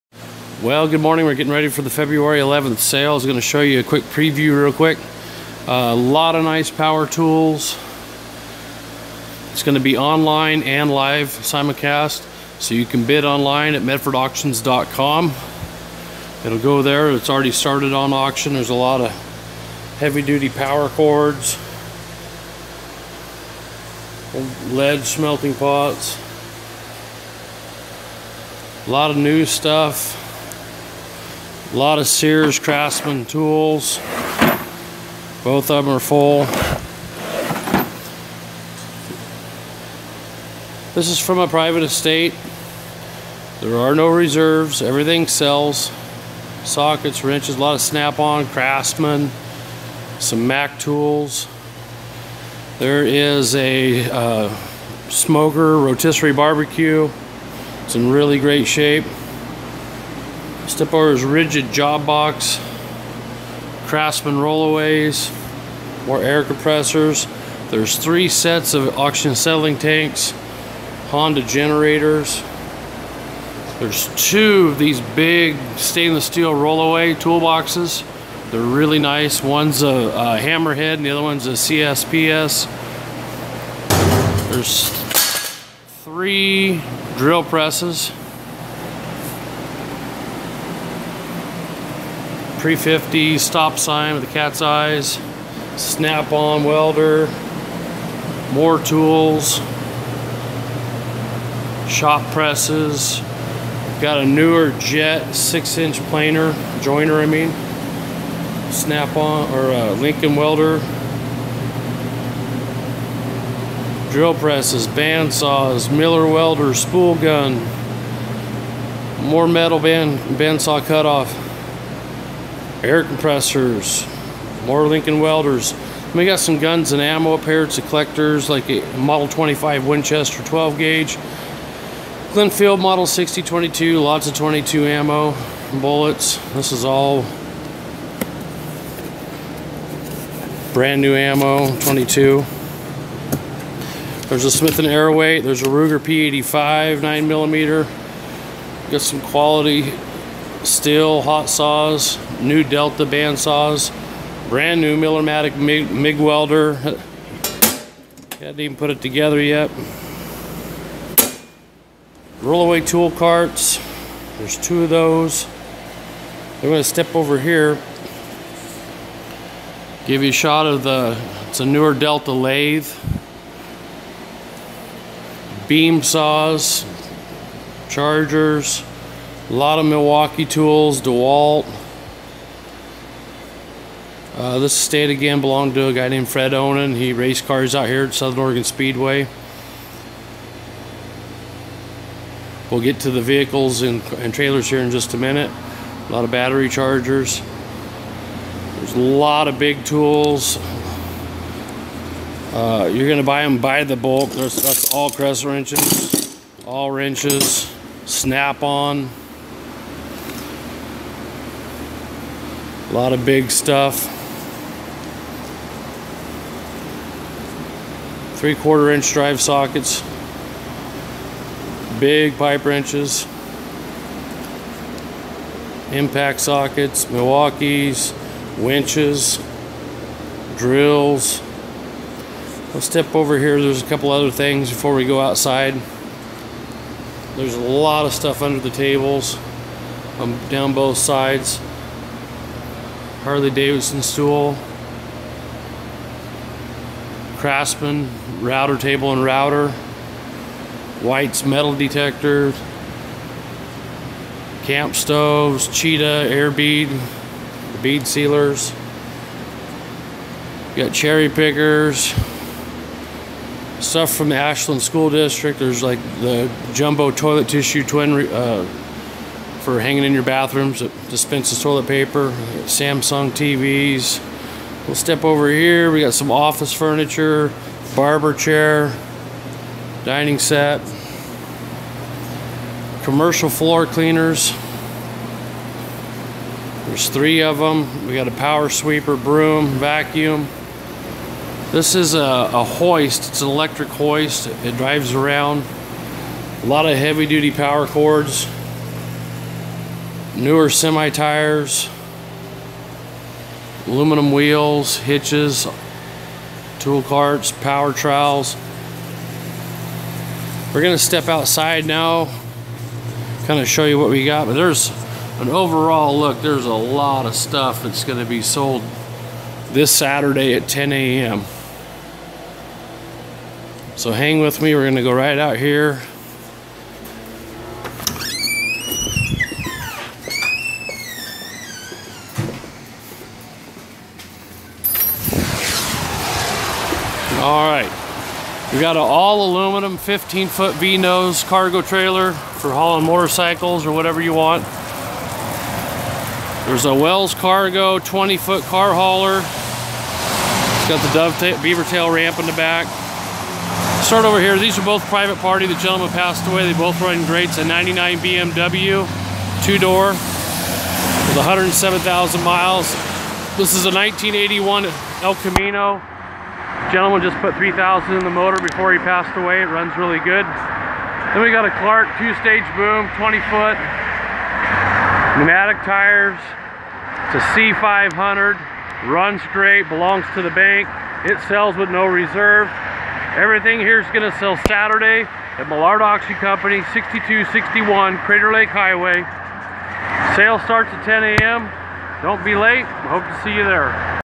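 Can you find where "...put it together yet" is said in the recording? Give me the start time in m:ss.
2:38.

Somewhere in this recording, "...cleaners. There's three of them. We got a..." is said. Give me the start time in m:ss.
4:43.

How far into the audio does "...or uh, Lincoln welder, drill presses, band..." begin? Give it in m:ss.
1:49.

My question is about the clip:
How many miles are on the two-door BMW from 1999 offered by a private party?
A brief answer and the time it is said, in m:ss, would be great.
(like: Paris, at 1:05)
107,000, at 6:01.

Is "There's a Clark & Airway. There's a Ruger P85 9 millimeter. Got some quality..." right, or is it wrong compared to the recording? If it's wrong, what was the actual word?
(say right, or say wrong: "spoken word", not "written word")
wrong: "Smith", not "Clark".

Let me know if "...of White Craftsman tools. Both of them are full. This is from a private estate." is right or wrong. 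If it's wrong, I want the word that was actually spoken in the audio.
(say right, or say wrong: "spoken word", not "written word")
wrong: "Sears", not "White".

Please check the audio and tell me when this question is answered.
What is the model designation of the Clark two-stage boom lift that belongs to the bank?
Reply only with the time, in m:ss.
6:17.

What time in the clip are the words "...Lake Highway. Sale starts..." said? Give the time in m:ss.
6:28.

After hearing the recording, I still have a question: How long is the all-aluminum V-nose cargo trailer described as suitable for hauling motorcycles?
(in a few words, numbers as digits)
15 feet.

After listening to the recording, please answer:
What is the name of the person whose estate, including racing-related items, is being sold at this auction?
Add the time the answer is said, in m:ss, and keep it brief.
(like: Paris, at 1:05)
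Fred Onan, at 3:06.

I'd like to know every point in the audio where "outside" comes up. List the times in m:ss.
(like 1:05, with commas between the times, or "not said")
3:55, 5:11.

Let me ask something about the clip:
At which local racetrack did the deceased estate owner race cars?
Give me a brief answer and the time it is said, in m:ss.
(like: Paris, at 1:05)
Southern Oregon Speedway, at 3:08.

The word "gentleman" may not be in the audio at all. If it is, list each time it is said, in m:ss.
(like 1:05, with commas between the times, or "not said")
5:55, 6:06.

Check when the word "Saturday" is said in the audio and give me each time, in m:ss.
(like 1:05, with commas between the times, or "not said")
5:19, 6:24.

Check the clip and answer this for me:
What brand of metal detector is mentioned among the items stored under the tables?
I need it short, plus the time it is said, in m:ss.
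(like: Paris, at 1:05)
White's, at 4:11.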